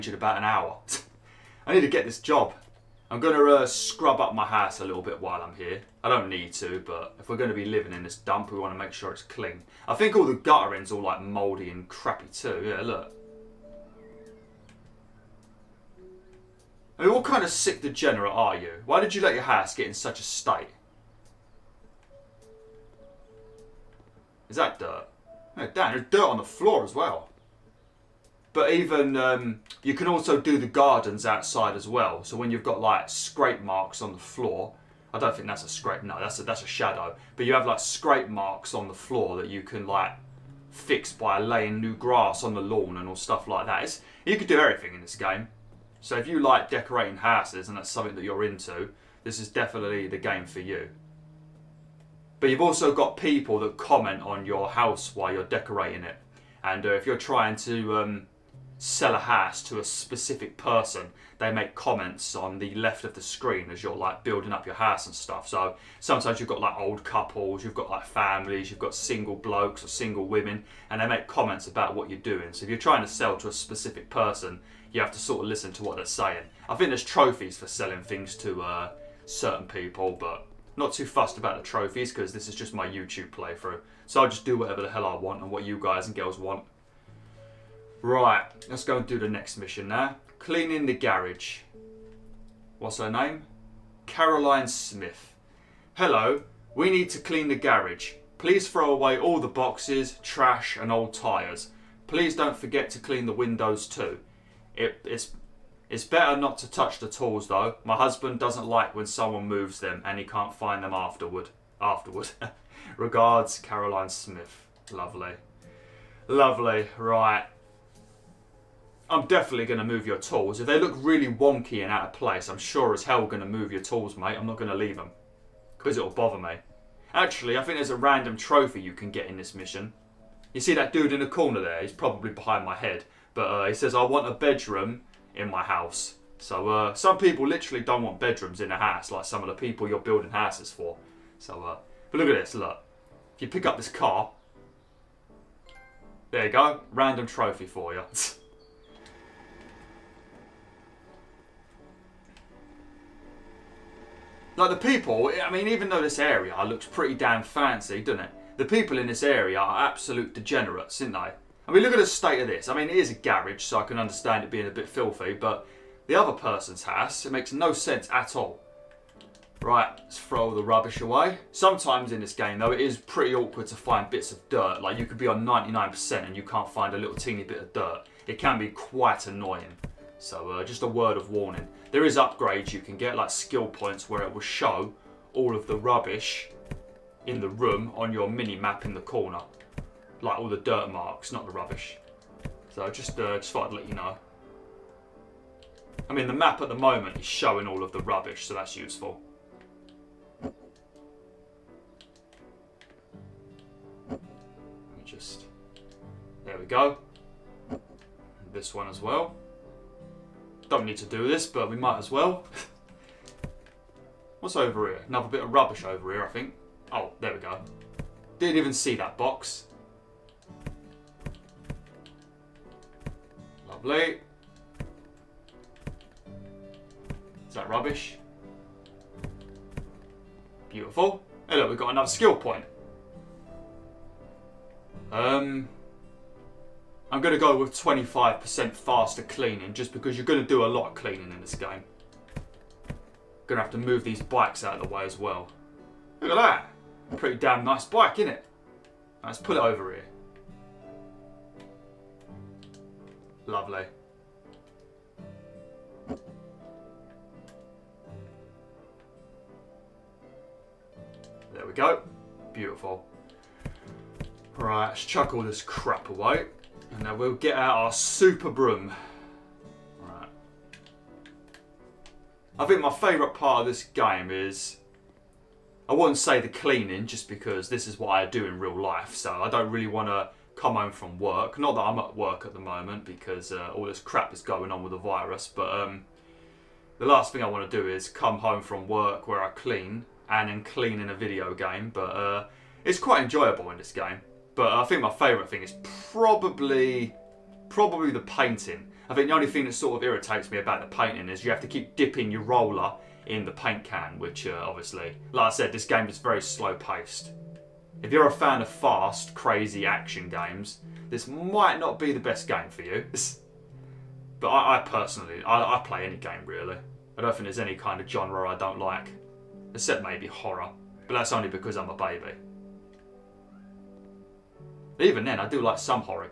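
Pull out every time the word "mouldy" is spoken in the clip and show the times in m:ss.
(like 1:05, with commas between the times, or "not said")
0:11.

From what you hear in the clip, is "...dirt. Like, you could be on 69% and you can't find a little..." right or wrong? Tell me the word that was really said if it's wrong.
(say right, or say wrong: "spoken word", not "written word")
wrong: "99", not "69".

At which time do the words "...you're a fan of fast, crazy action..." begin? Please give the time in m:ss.
5:08.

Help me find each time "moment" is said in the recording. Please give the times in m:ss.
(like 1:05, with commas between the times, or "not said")
3:16, 4:42.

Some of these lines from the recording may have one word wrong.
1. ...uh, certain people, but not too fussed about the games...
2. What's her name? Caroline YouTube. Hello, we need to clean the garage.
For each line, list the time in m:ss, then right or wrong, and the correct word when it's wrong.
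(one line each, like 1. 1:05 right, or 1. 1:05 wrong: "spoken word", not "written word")
1. 1:18 wrong: "trophies", not "games"
2. 1:32 wrong: "Smith", not "YouTube".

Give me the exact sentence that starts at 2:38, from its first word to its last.
The people in this area are absolute degenerates, aren't they?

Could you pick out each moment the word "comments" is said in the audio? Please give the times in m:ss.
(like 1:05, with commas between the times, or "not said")
0:53, 1:01, 1:11.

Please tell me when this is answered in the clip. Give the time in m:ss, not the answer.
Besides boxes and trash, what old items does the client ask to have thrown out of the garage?
1:40.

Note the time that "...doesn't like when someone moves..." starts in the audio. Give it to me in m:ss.
1:48.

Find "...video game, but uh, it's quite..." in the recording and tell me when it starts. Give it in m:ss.
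4:51.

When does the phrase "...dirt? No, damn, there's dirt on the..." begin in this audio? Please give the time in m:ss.
0:24.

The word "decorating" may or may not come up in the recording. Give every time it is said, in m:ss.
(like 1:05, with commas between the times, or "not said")
0:46, 0:55.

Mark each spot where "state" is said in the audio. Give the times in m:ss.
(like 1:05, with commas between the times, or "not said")
0:20, 2:42.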